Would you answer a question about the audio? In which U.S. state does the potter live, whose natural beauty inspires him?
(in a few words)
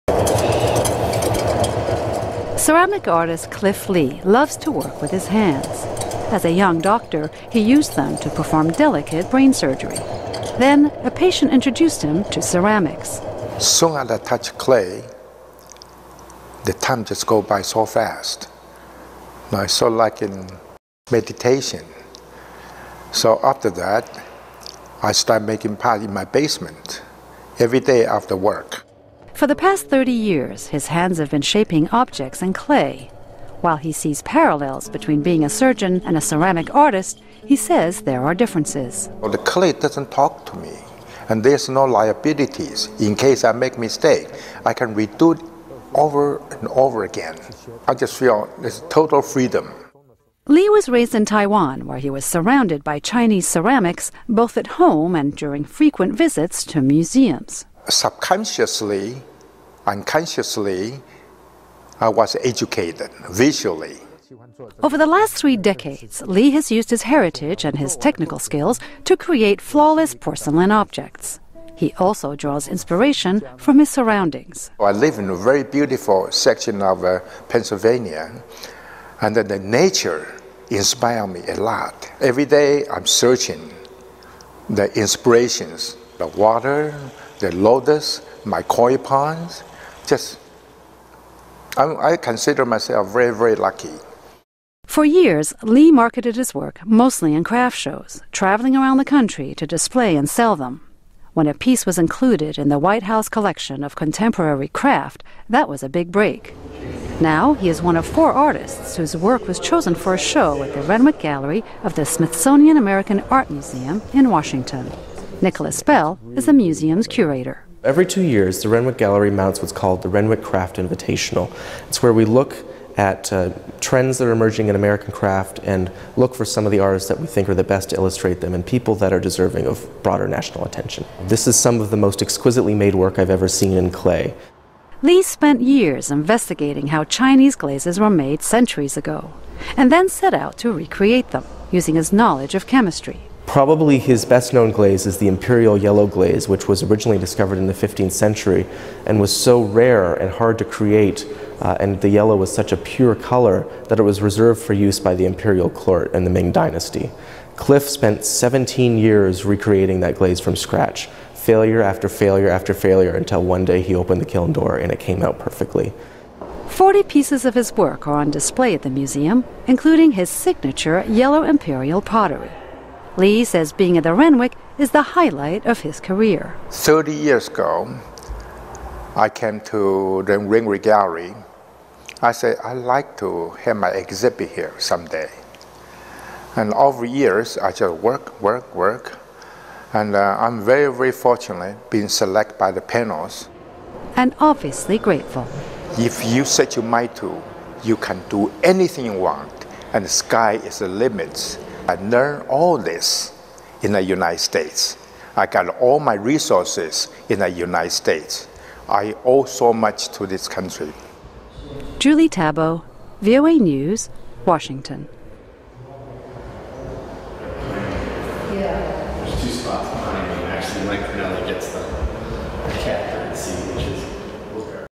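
Pennsylvania.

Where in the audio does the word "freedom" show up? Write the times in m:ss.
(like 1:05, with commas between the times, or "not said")
0:49.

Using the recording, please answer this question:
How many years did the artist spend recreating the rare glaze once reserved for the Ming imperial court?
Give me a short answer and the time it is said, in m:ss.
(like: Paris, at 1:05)
17, at 2:38.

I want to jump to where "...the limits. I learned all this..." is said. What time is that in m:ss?
3:20.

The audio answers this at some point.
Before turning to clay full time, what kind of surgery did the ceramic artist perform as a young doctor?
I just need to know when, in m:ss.
0:09.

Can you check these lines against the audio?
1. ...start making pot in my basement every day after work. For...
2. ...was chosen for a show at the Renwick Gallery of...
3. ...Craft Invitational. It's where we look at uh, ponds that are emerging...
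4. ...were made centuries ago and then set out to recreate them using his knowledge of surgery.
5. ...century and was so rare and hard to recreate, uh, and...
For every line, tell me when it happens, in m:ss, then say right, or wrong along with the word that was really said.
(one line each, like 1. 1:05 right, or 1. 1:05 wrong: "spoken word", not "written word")
1. 0:25 right
2. 1:49 right
3. 2:00 wrong: "trends", not "ponds"
4. 2:17 wrong: "chemistry", not "surgery"
5. 2:28 wrong: "create", not "recreate".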